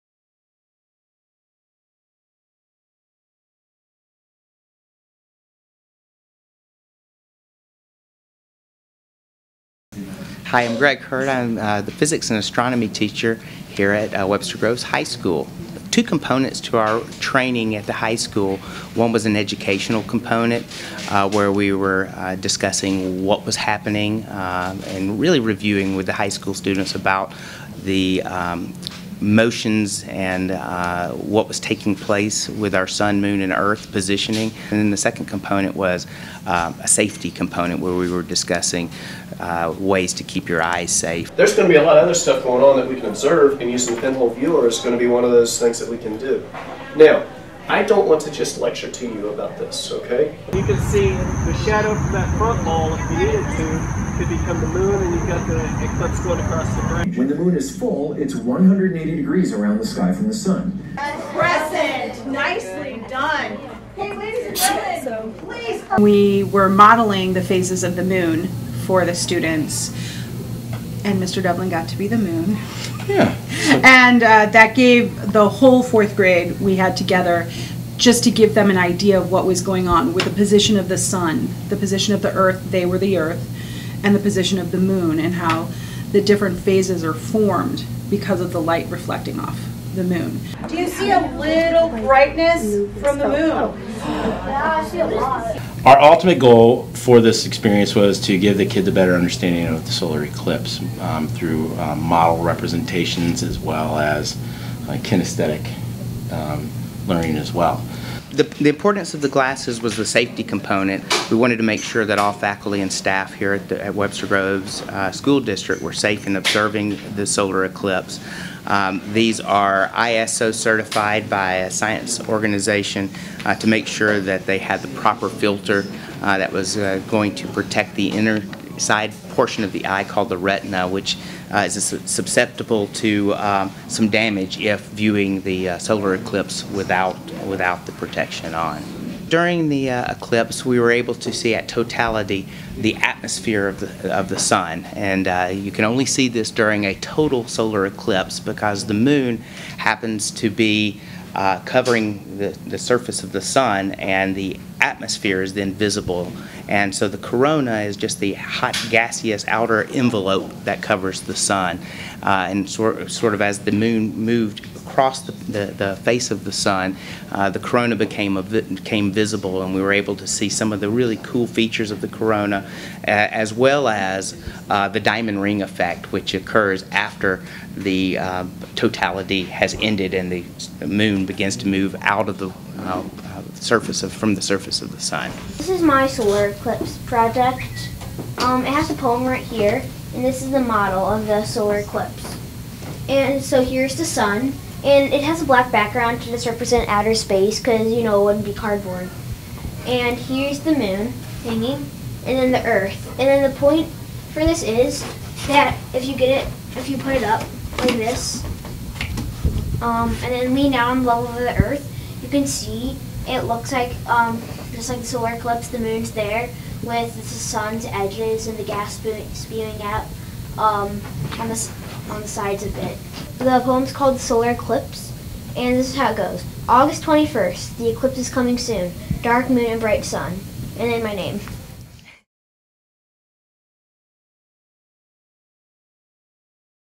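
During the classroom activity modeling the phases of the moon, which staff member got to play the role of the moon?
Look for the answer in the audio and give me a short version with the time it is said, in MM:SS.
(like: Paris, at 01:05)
Mr. Dublin, at 01:11.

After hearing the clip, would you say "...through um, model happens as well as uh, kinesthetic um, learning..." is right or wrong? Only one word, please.
wrong.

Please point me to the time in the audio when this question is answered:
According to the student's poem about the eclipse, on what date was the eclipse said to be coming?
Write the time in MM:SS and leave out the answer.
03:46.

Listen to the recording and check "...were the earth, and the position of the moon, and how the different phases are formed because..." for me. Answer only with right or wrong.
right.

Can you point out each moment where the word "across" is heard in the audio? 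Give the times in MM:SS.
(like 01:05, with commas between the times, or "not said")
00:56, 02:44.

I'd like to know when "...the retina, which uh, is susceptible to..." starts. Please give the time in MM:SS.
02:10.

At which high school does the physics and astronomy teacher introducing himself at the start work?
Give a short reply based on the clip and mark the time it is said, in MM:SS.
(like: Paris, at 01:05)
Webster Groves High School, at 00:14.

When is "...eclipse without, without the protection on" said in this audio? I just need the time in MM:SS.
02:16.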